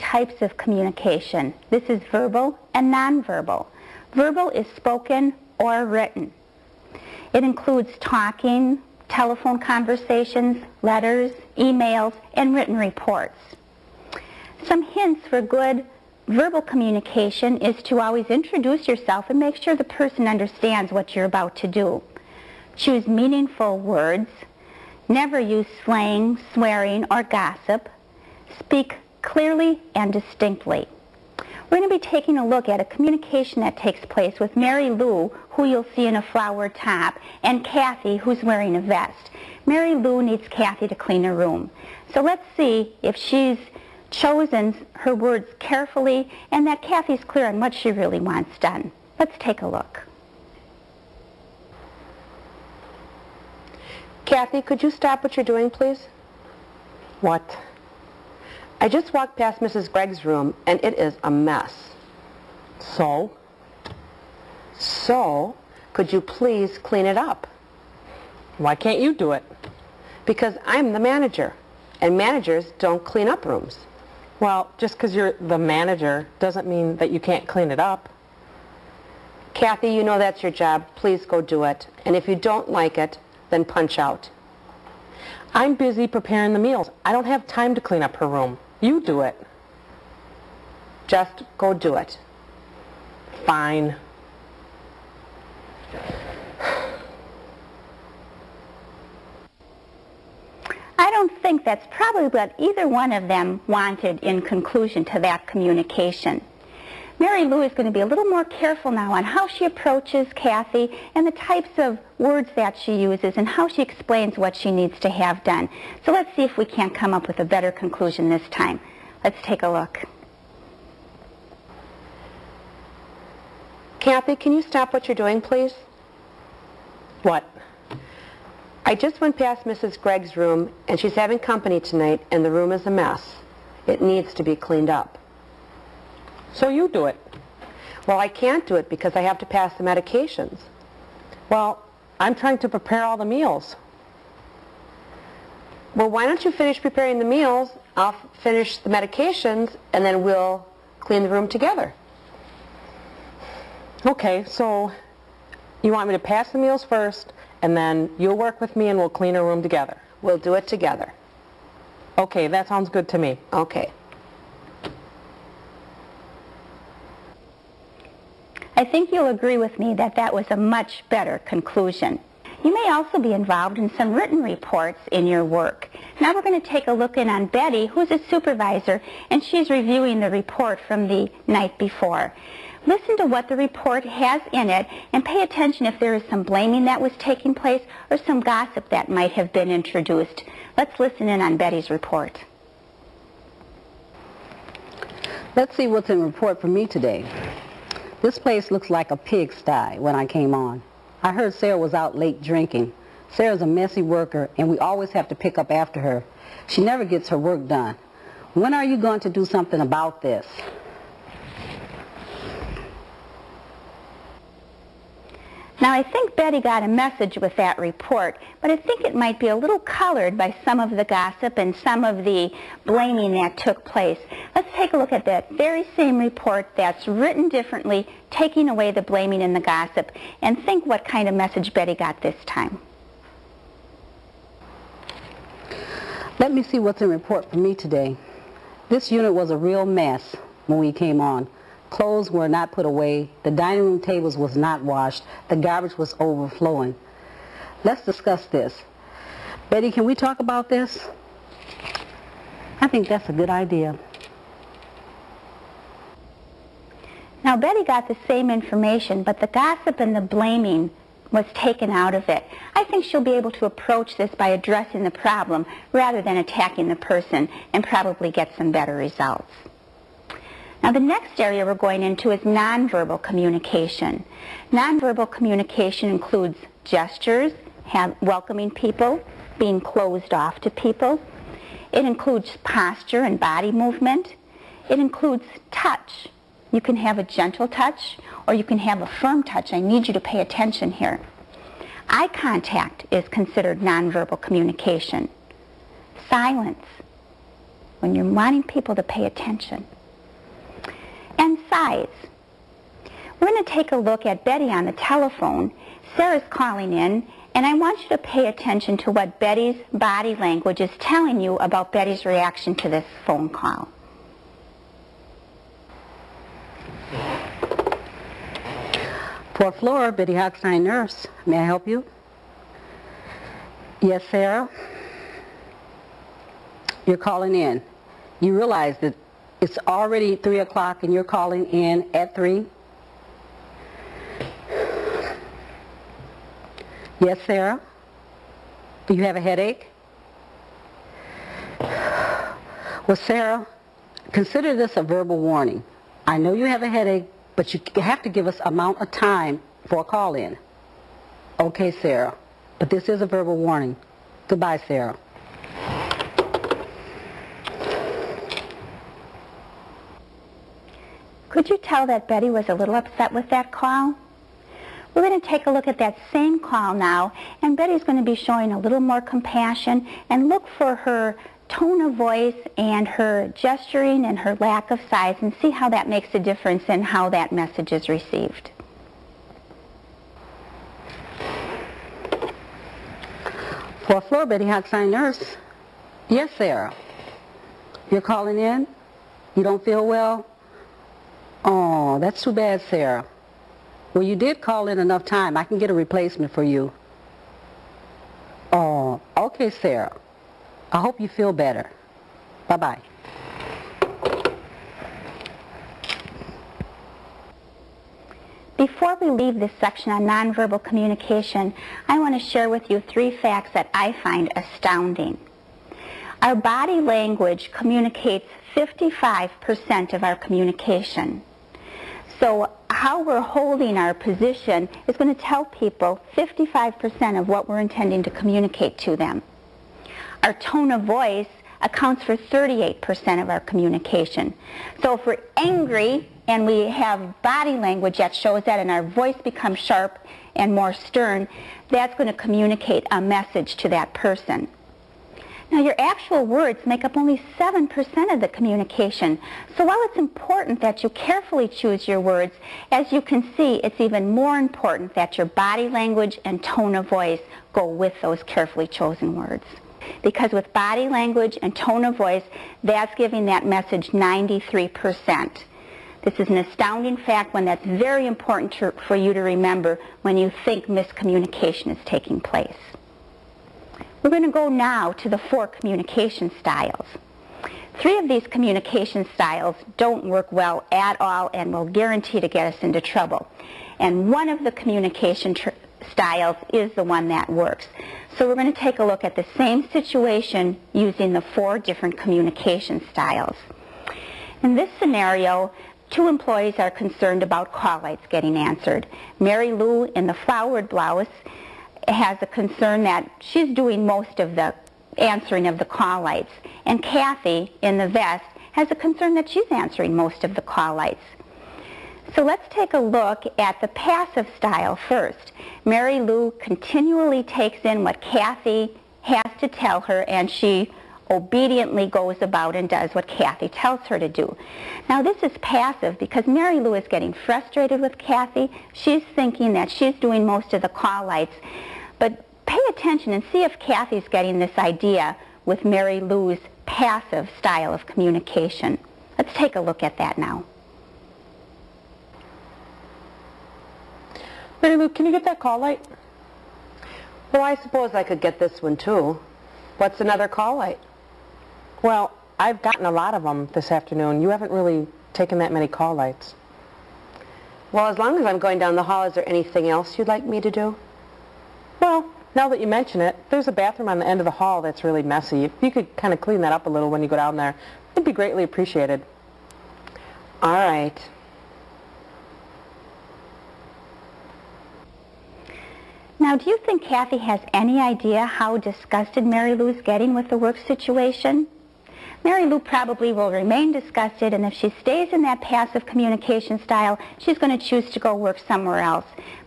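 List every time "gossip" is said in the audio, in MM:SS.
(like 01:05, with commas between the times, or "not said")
00:27, 03:08, 03:41, 03:49, 04:19.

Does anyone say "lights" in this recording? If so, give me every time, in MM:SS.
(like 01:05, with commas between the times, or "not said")
08:18, 08:26, 08:30, 08:51, 09:05, 09:10, 09:16.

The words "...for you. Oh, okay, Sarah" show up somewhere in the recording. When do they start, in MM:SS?
06:36.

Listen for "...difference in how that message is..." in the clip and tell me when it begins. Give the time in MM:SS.
06:16.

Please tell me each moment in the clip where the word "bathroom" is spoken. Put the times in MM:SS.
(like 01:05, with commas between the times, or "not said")
09:23.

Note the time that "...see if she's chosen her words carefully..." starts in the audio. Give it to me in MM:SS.
00:42.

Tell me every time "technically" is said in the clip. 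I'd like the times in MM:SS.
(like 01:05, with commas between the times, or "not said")
not said.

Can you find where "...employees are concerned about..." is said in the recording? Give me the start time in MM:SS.
08:16.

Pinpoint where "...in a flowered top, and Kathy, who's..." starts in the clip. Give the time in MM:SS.
00:36.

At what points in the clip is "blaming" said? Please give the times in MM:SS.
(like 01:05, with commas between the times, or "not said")
03:06, 03:42, 03:49, 04:20.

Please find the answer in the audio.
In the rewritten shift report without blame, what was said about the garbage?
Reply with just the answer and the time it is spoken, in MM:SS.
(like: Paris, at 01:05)
overflowing, at 04:06.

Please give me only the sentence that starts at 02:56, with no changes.
Now we're going to take a look in on Betty, who's a supervisor, and she's reviewing the report from the night before.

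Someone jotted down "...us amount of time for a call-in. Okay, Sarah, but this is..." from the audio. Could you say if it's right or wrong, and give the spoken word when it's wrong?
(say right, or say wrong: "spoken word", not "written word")
right.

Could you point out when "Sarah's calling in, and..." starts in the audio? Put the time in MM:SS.
05:06.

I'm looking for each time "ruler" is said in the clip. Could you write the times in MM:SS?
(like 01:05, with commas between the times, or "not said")
not said.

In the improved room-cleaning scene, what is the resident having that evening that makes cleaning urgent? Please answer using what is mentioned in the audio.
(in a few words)
company.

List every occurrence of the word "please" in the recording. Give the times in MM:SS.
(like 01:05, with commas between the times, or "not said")
00:55, 01:06, 01:20, 02:05.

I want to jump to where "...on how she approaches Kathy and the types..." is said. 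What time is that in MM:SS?
01:49.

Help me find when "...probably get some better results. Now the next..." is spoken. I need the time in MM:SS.
04:27.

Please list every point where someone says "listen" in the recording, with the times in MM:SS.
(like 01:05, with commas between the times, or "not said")
03:02, 03:11.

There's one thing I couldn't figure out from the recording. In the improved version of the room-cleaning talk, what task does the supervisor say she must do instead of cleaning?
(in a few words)
pass the medications.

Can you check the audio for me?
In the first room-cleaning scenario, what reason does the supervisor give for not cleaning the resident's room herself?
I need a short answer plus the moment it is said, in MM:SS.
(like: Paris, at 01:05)
I'm the manager, at 01:10.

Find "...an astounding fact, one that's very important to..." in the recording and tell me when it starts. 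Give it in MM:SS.
07:46.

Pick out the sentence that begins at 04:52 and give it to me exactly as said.
Eye contact is considered nonverbal communication.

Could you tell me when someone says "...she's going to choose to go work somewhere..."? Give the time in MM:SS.
09:47.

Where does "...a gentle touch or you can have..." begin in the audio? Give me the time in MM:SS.
04:47.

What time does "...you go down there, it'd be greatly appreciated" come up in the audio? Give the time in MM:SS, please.
09:27.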